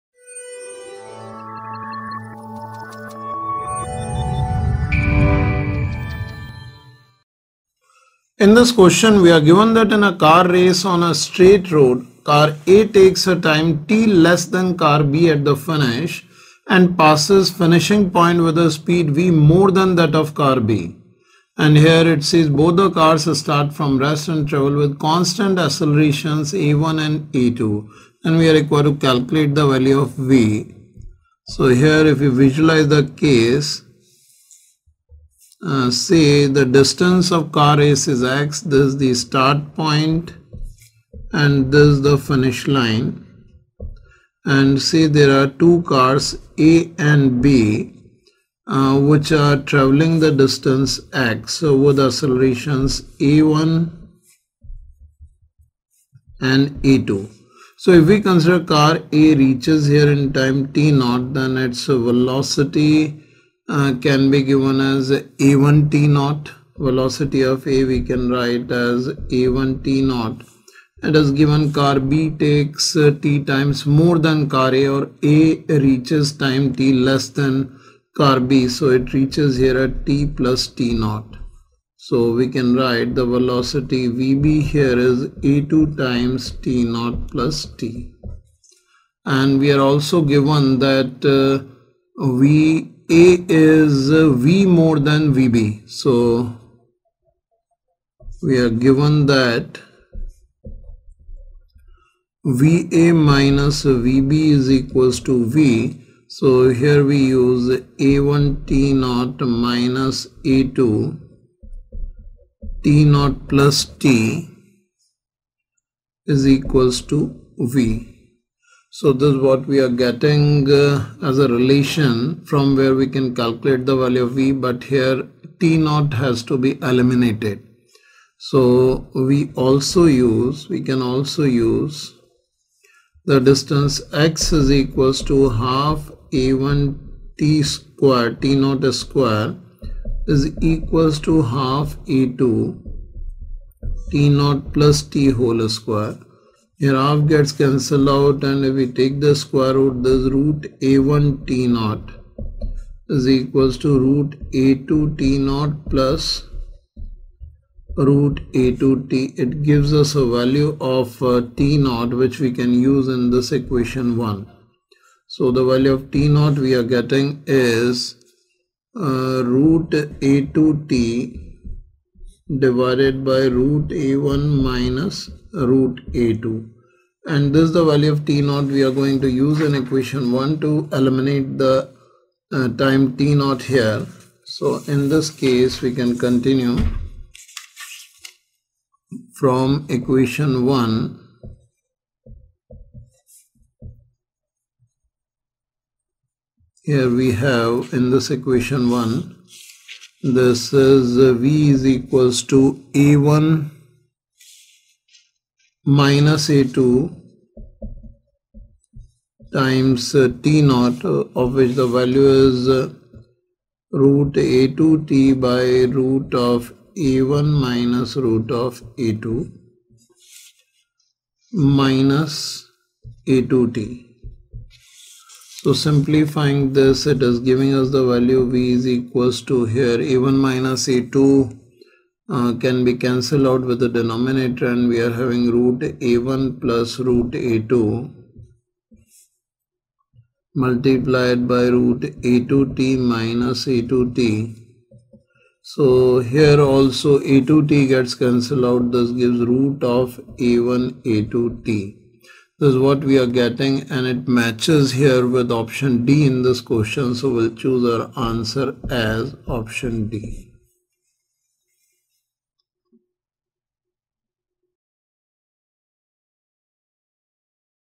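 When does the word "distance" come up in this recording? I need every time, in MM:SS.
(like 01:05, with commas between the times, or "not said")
00:36, 00:50, 02:13.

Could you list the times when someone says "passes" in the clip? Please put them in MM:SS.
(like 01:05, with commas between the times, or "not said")
00:16.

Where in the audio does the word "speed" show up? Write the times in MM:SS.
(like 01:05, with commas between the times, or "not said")
00:18.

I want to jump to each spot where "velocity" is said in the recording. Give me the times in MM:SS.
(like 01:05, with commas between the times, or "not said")
01:01, 01:06, 01:23.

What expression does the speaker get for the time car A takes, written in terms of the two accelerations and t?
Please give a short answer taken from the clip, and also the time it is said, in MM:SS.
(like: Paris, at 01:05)
root a2 t / (root a1 - root a2), at 02:49.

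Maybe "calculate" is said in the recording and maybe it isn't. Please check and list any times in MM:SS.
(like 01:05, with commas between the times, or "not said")
00:28, 02:03.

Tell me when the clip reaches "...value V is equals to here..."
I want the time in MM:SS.
03:48.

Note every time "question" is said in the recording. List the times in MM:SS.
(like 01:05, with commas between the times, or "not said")
00:08, 04:16.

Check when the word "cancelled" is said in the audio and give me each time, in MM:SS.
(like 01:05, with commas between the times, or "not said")
02:27, 03:52, 04:08.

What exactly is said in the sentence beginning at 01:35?
So we are given that VA minus VB is equals to V.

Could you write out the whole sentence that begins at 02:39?
It gives us a value of uh, t naught which we can use in this equation 1.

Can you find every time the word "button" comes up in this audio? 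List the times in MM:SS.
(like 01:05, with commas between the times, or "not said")
not said.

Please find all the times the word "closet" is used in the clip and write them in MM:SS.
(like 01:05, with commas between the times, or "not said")
not said.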